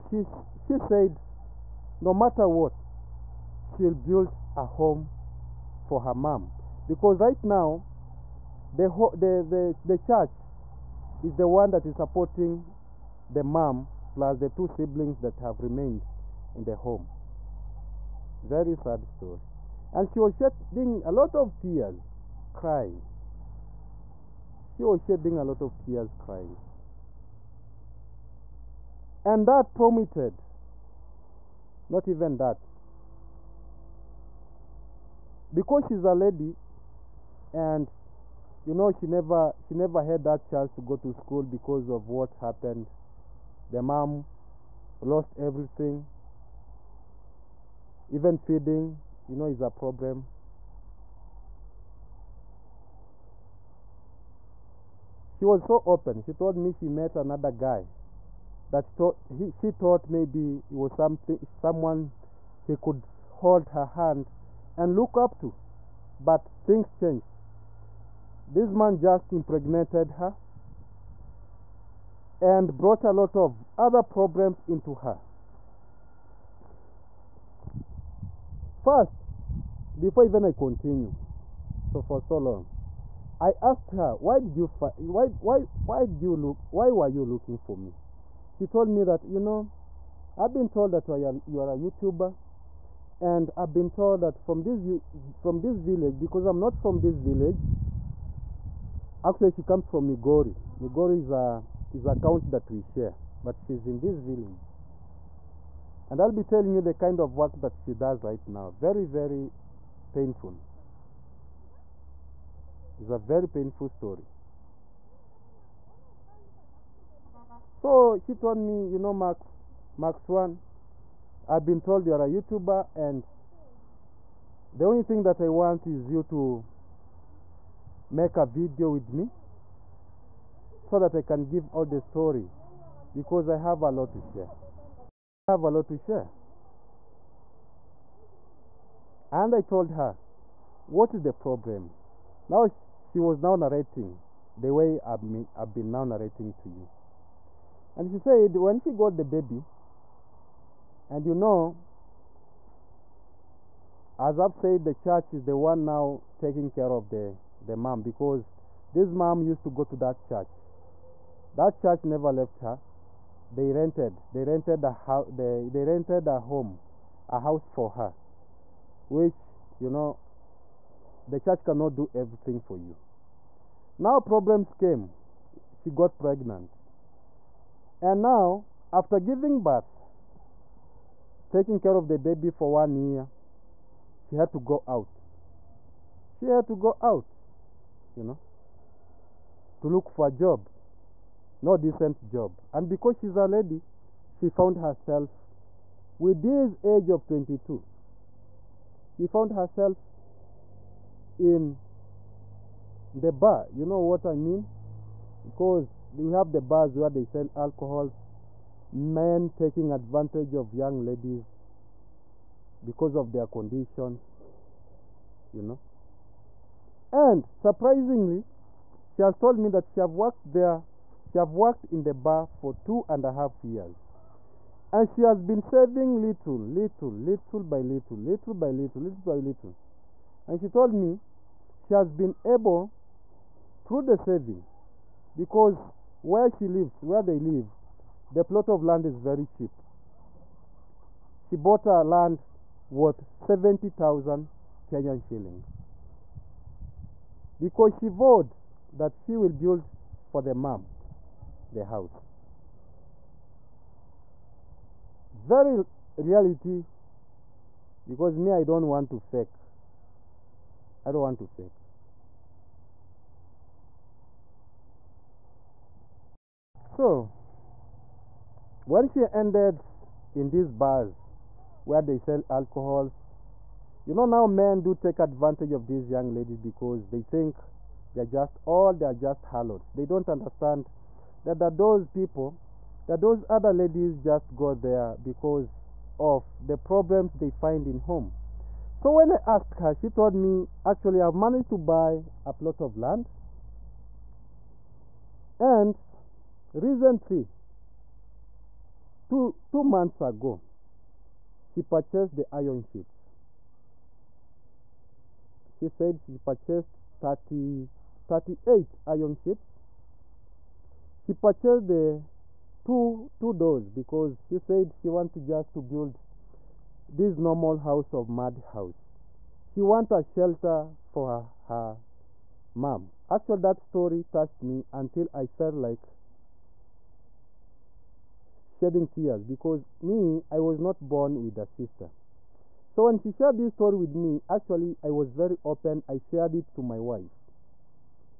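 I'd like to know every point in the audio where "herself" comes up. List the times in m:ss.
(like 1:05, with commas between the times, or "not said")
3:14, 3:19.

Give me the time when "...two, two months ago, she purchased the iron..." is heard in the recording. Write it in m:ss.
4:59.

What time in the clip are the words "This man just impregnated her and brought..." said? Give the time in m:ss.
1:08.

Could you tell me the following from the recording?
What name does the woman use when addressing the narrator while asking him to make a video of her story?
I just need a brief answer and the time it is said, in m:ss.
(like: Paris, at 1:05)
Max One, at 1:59.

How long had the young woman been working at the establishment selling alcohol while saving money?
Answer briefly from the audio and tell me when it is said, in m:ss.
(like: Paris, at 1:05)
two and a half years, at 3:42.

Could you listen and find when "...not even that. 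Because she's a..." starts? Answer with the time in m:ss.
0:31.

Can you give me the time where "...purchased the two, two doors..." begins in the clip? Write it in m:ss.
5:11.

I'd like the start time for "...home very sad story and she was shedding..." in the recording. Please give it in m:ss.
0:16.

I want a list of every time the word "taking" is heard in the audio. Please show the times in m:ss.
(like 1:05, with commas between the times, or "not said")
2:36, 3:01, 3:29.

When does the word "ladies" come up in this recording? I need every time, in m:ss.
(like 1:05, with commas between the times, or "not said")
3:31, 4:36, 4:43.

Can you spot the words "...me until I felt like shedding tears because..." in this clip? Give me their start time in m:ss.
5:24.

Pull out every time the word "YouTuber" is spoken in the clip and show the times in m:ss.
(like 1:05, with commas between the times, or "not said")
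1:31, 2:02.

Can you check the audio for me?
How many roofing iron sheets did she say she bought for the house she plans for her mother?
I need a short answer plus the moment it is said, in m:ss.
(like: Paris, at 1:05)
38, at 5:08.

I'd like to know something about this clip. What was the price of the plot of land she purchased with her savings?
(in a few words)
70,000 Kenyan shillings.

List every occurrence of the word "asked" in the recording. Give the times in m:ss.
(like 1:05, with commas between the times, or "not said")
1:23, 4:49.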